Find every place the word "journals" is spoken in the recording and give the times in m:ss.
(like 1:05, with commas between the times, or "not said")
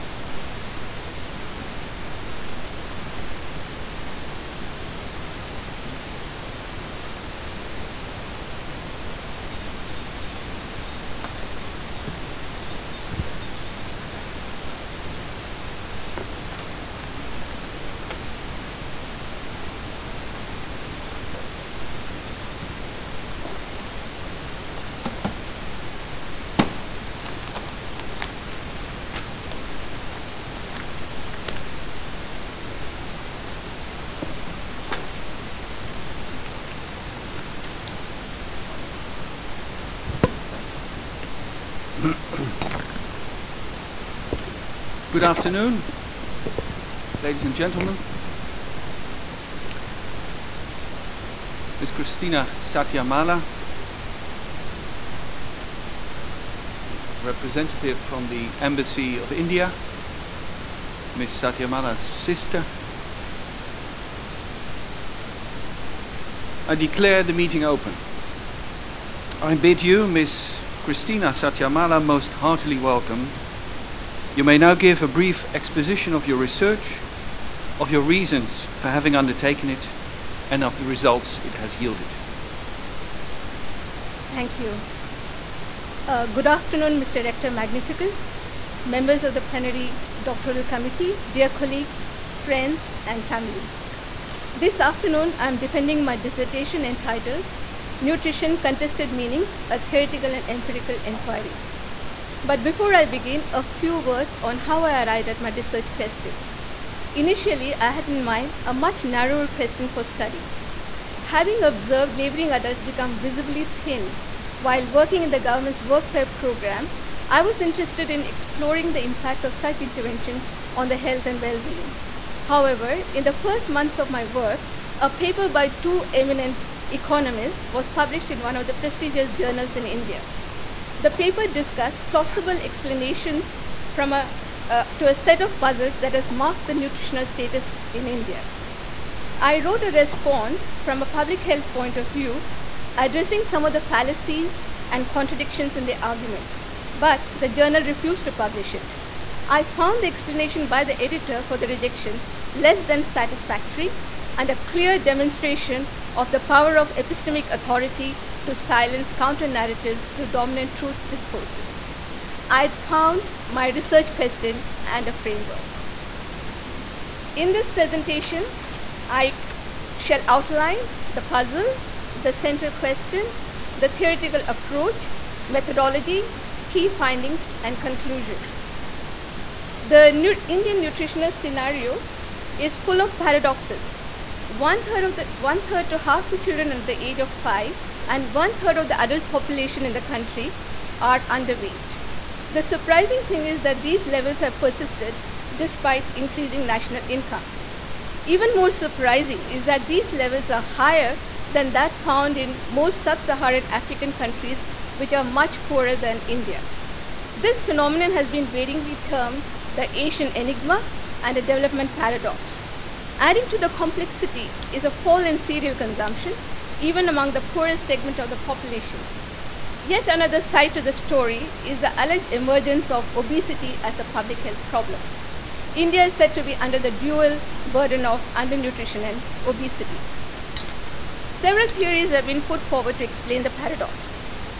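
2:09, 2:27.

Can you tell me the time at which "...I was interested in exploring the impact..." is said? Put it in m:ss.
1:57.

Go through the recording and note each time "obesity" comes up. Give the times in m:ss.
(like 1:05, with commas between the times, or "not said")
3:43, 3:49.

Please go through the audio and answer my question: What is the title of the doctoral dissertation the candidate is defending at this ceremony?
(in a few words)
Nutrition Contested Meanings.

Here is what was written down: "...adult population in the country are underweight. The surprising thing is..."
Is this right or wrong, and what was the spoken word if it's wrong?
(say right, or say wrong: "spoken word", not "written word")
right.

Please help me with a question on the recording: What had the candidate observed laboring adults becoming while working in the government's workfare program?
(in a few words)
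visibly thin.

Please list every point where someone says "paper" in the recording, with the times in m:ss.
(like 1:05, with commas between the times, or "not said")
2:05, 2:11.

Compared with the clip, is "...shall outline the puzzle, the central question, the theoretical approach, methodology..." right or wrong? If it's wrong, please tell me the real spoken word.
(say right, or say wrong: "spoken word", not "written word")
right.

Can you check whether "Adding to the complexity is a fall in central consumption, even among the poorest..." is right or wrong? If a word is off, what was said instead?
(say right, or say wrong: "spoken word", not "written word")
wrong: "cereal", not "central".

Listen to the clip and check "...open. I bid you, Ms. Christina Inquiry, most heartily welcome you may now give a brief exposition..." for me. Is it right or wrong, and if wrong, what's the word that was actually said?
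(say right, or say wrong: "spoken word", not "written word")
wrong: "Sathyamala", not "Inquiry".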